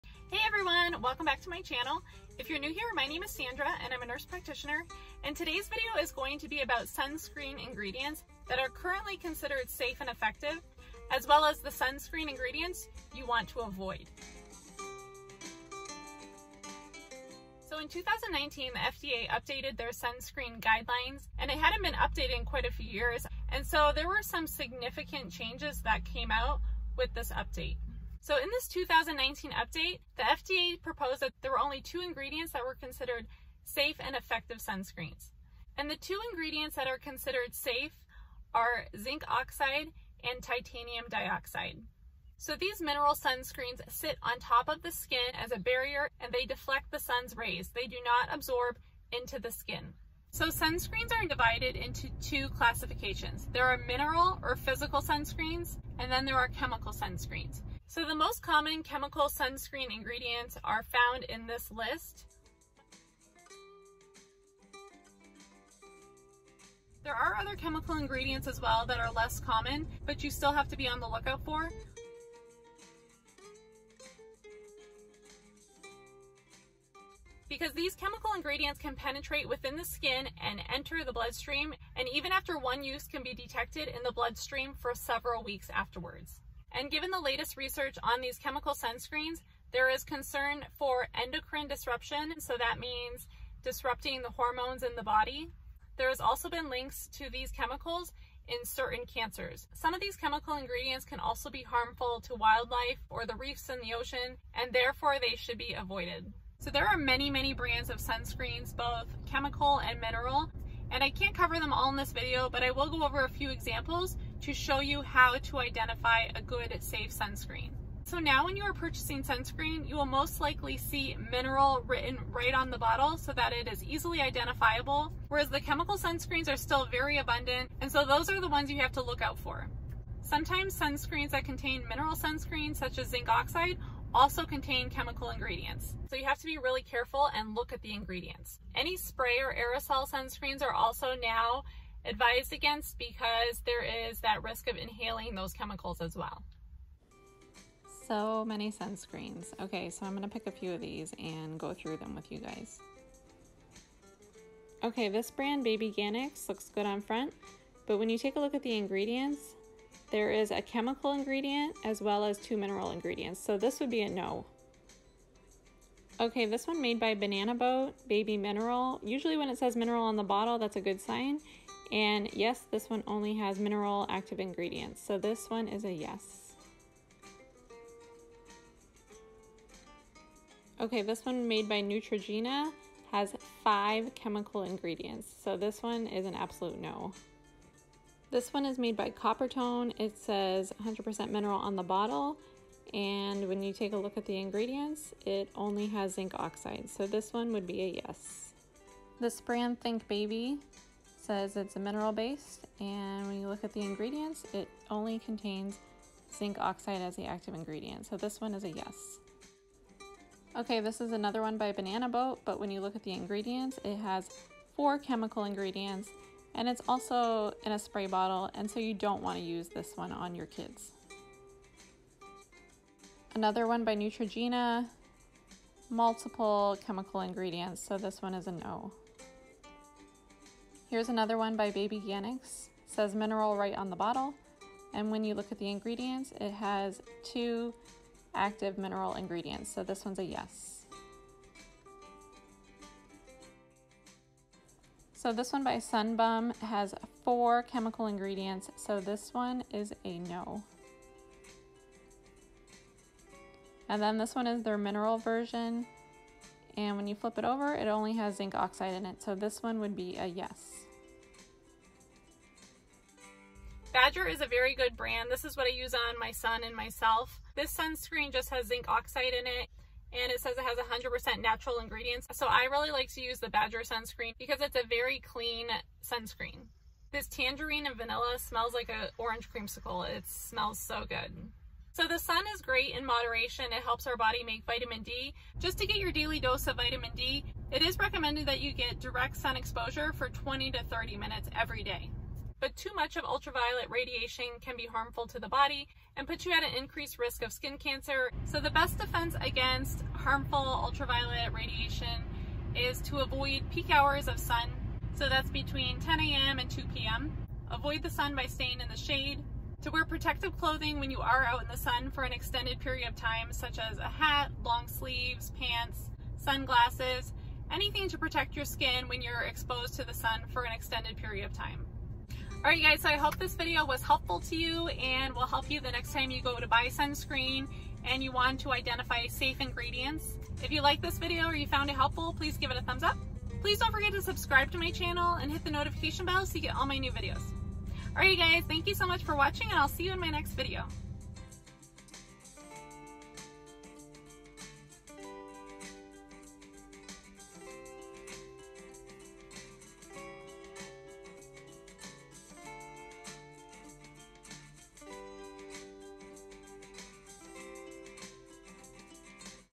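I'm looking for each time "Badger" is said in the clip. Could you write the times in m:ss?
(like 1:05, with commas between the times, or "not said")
4:23, 4:33.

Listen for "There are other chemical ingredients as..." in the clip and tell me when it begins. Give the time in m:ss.
1:07.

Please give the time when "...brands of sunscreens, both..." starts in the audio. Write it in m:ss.
1:47.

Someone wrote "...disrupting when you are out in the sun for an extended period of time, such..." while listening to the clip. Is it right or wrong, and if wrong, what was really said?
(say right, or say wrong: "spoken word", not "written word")
wrong: "clothing", not "disrupting".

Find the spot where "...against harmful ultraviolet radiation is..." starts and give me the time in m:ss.
4:59.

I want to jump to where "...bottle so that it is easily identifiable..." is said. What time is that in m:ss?
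2:02.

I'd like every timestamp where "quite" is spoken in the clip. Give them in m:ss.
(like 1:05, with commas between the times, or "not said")
0:22.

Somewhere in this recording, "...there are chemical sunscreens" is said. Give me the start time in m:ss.
0:56.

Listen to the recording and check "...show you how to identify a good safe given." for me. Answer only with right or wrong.
wrong.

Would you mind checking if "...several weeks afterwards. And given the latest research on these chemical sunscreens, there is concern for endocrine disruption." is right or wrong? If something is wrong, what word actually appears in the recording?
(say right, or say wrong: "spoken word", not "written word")
right.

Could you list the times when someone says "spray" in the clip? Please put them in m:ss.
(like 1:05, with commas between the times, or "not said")
2:18, 3:37.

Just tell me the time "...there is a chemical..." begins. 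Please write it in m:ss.
2:40.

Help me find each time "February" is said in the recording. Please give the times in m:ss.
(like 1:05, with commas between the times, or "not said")
not said.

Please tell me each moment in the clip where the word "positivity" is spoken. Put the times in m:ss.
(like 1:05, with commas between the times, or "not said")
not said.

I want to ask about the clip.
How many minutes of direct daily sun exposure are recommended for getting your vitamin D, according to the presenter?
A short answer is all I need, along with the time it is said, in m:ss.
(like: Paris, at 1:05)
20 to 30 minutes, at 4:50.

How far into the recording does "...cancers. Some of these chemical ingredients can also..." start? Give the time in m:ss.
1:39.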